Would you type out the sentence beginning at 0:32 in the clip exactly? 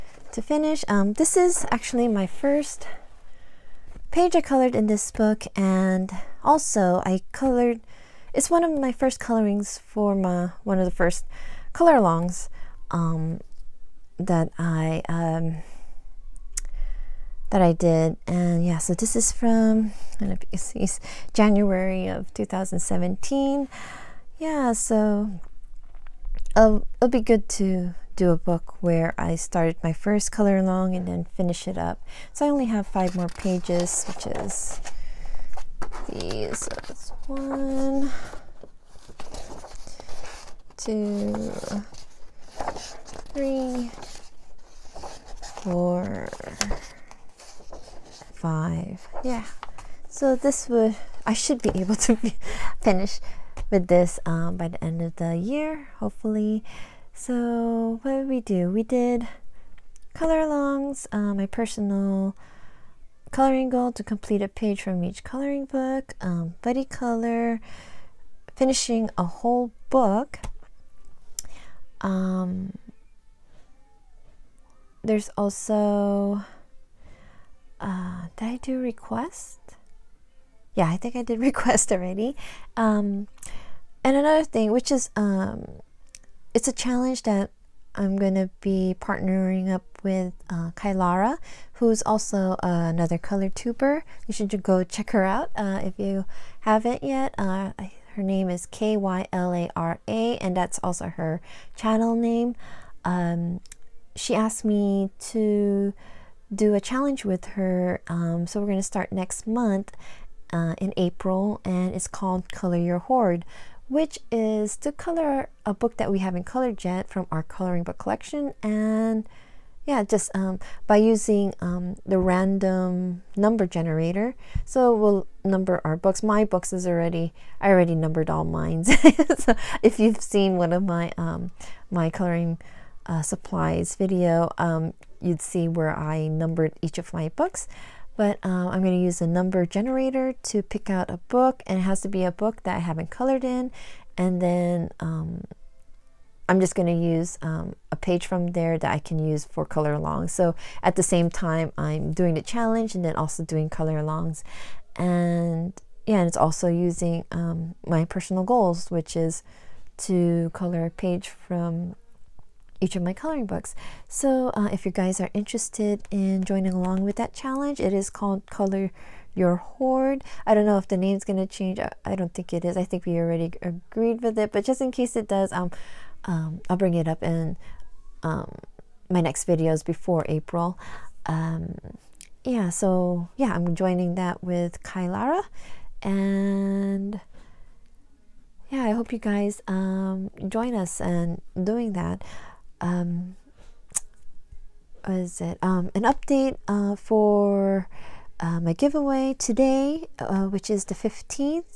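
So I only have five more pages, which is these.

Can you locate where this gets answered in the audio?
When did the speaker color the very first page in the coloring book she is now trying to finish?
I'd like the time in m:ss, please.
0:21.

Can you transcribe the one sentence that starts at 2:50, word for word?
I don't know if the name's going to change.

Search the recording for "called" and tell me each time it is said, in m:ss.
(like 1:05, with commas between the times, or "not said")
1:52, 2:48.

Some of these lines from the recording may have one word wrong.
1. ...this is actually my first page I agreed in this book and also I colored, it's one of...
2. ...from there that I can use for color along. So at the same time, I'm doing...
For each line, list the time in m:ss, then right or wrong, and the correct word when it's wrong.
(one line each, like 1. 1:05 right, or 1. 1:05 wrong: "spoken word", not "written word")
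1. 0:01 wrong: "colored", not "agreed"
2. 2:28 right.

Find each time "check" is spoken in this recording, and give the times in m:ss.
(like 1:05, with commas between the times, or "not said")
1:34.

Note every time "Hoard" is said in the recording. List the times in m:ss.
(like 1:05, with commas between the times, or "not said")
1:52, 2:49.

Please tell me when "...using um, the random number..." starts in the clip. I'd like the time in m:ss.
2:00.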